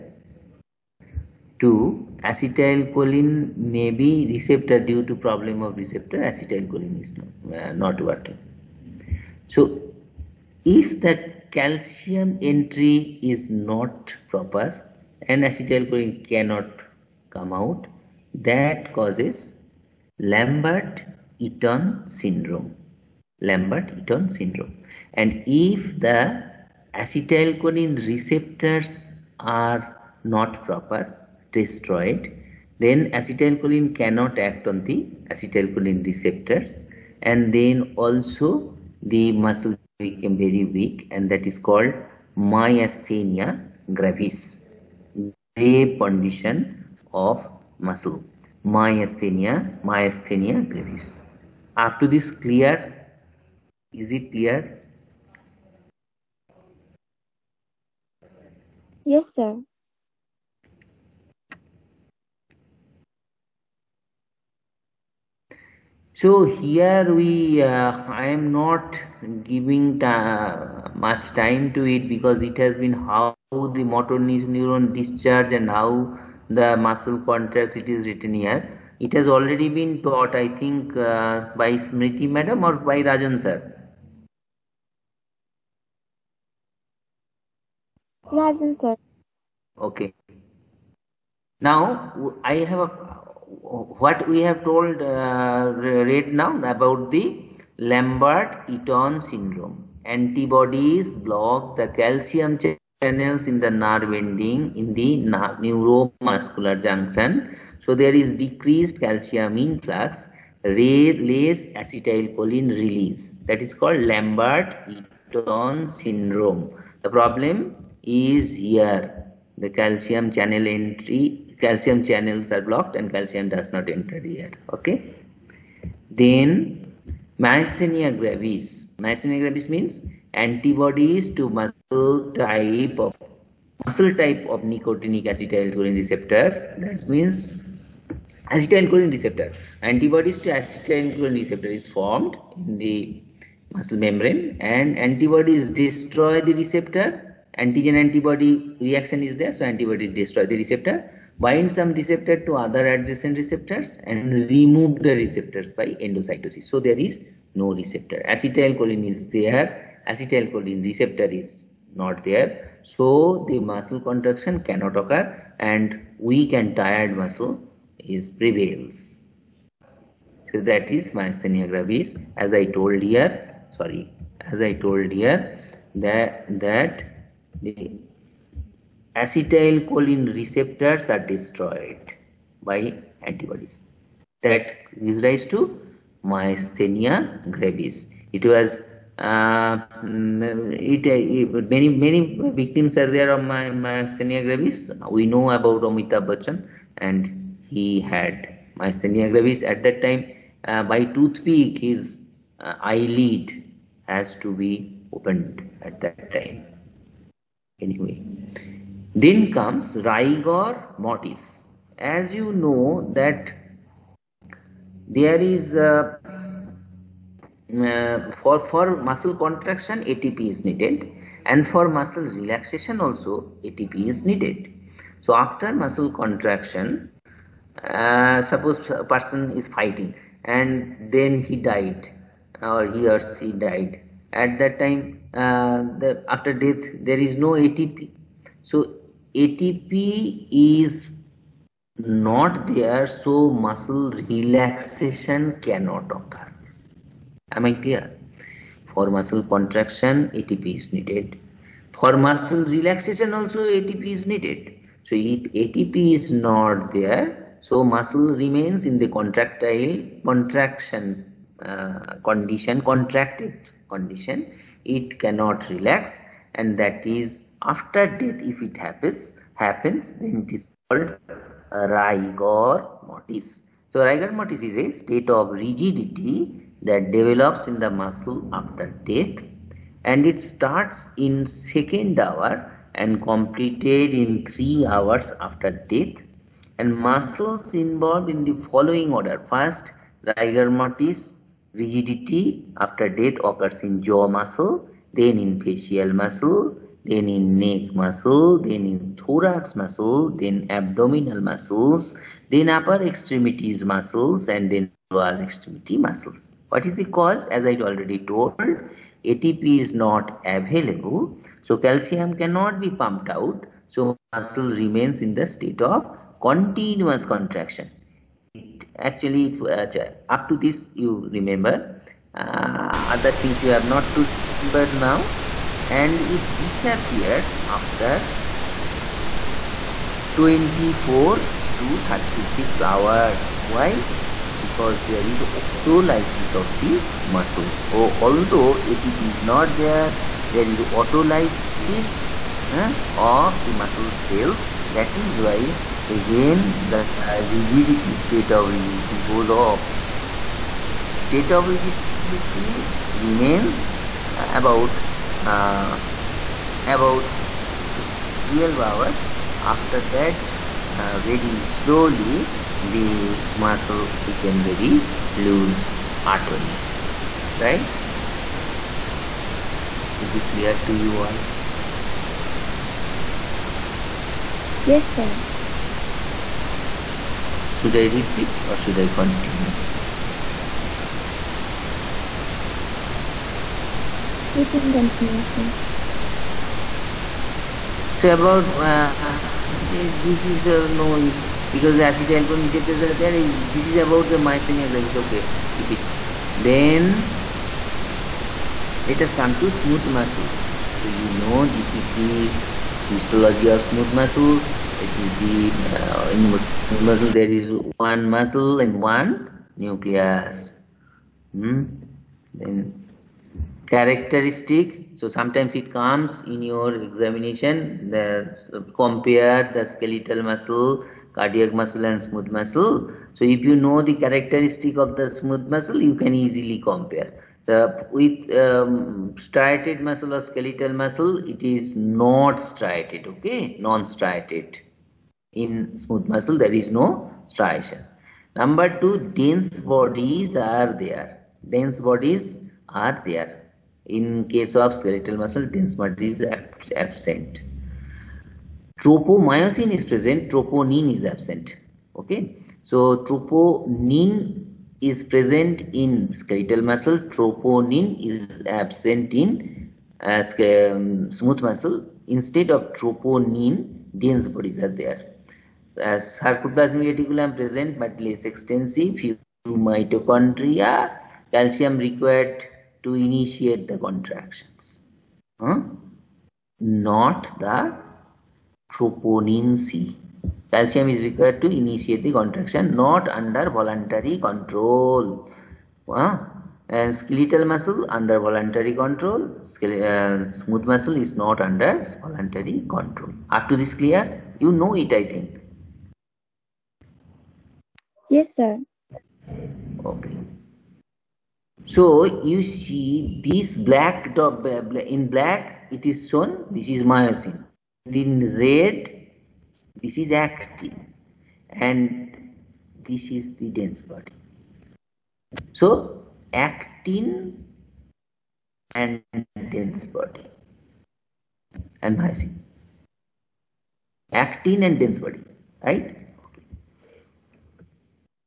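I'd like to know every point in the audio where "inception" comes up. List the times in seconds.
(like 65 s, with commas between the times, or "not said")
not said.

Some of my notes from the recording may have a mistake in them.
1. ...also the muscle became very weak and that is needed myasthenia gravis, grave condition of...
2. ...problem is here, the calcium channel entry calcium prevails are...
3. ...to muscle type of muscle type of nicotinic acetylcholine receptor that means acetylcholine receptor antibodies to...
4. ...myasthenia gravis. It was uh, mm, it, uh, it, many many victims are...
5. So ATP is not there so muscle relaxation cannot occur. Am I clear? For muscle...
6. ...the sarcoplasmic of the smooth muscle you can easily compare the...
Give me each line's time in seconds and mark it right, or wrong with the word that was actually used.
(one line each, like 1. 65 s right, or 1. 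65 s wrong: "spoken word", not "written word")
1. 37 s wrong: "called", not "needed"
2. 117 s wrong: "channels", not "prevails"
3. 131 s right
4. 186 s right
5. 238 s right
6. 424 s wrong: "characteristic", not "sarcoplasmic".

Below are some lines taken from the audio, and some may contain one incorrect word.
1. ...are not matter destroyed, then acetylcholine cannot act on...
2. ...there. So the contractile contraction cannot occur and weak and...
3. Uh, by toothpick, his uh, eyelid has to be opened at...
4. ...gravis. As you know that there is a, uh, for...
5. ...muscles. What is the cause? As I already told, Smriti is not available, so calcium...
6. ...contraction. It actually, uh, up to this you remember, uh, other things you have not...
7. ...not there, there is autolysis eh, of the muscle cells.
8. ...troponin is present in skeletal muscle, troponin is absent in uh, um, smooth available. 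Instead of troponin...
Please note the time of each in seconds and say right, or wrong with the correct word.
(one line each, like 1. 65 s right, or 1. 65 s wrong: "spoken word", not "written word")
1. 29 s wrong: "proper", not "matter"
2. 162 s wrong: "muscle", not "contractile"
3. 200 s right
4. 210 s wrong: "mortis", not "gravis"
5. 305 s wrong: "ATP", not "Smriti"
6. 317 s right
7. 339 s right
8. 453 s wrong: "muscle", not "available".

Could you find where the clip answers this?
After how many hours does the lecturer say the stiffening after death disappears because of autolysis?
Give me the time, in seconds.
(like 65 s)
330 s.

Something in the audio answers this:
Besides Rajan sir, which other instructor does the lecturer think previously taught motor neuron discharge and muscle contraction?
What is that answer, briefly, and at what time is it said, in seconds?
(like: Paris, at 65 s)
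Smriti madam, at 81 s.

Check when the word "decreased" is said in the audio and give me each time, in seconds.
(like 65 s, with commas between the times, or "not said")
108 s.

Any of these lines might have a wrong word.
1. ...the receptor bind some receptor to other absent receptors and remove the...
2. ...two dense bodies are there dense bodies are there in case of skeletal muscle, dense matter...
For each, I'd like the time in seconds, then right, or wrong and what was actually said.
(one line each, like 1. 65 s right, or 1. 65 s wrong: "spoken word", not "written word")
1. 150 s wrong: "adjacent", not "absent"
2. 439 s right.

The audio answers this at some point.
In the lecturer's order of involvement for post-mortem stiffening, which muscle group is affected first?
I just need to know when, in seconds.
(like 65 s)
294 s.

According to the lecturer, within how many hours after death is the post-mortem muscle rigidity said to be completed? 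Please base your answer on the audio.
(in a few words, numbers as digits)
3 hours.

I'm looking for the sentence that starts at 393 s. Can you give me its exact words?
This is about the myasthenia gravis.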